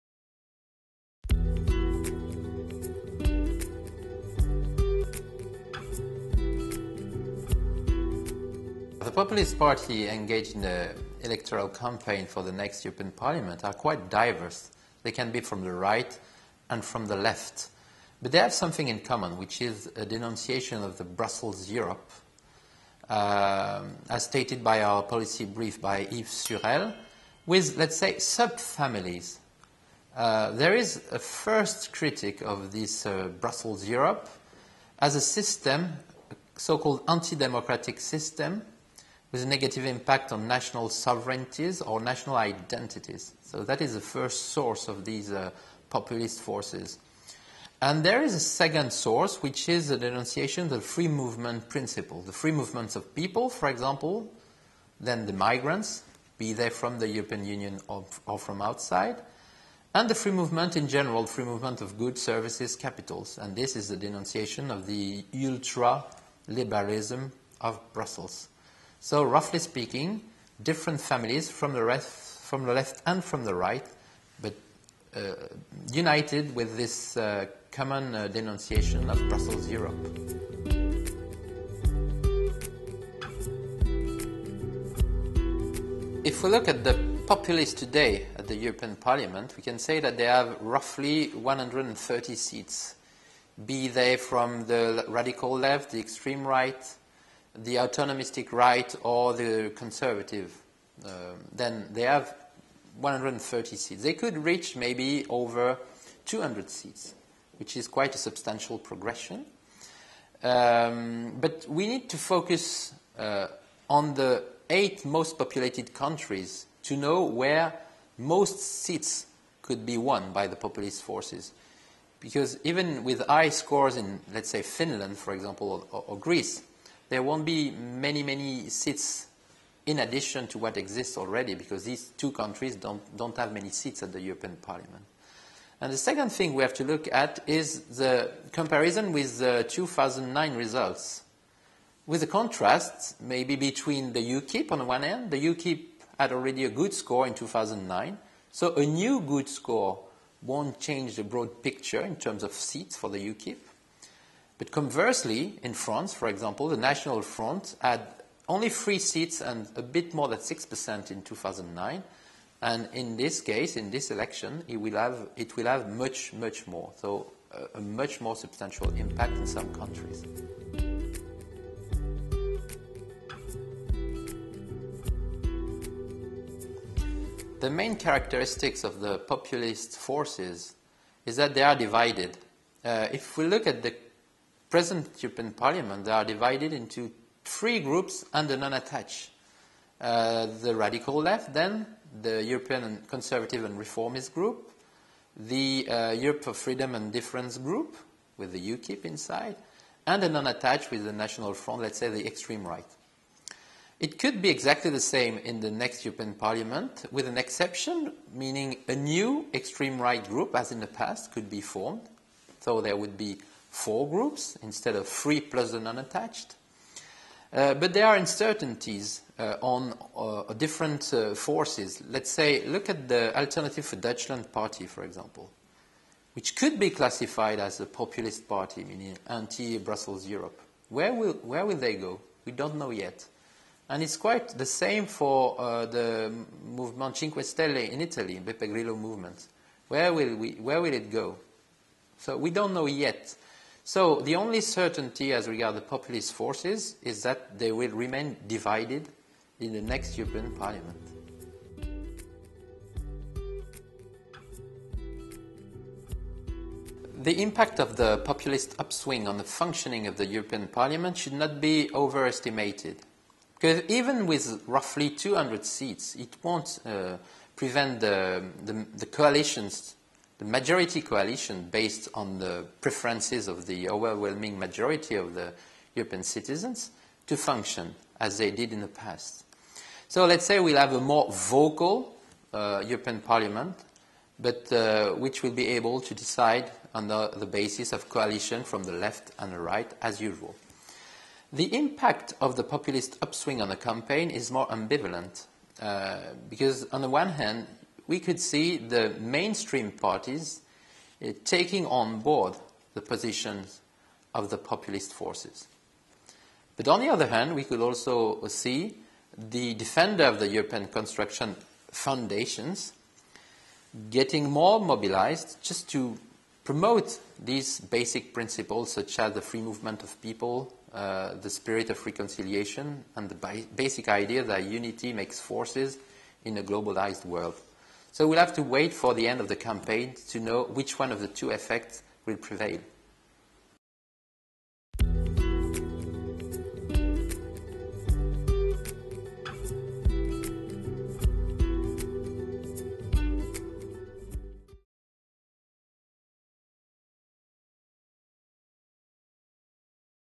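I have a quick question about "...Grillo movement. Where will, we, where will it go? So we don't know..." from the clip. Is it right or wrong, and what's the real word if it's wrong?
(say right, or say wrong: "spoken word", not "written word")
right.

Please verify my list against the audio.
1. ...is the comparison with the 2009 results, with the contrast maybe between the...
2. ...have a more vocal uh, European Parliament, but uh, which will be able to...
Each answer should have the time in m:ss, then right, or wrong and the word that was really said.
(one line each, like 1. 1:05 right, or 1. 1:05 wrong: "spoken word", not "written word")
1. 2:17 right
2. 4:40 right.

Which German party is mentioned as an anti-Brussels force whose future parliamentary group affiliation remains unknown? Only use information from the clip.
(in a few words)
Alternative for Deutschland.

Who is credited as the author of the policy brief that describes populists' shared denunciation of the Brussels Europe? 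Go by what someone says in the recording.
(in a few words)
Yves Surel.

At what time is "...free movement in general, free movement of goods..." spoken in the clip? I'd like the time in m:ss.
1:00.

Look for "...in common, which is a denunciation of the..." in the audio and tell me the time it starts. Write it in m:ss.
0:18.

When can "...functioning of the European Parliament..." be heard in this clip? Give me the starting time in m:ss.
4:19.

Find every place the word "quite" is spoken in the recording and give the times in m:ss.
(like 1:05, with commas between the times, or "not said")
0:13, 1:47, 3:54.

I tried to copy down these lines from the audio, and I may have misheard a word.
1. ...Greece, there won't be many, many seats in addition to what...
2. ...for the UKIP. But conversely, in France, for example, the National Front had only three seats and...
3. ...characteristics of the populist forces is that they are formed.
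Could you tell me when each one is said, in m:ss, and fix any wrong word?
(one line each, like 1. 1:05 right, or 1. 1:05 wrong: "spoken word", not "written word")
1. 2:06 right
2. 2:32 right
3. 2:57 wrong: "divided", not "formed".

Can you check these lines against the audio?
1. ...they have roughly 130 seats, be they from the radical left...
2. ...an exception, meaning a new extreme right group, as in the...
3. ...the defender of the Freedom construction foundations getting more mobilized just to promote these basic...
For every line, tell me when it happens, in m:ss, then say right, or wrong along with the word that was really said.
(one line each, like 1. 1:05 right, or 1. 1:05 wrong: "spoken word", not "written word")
1. 1:30 right
2. 3:27 right
3. 5:09 wrong: "European", not "Freedom".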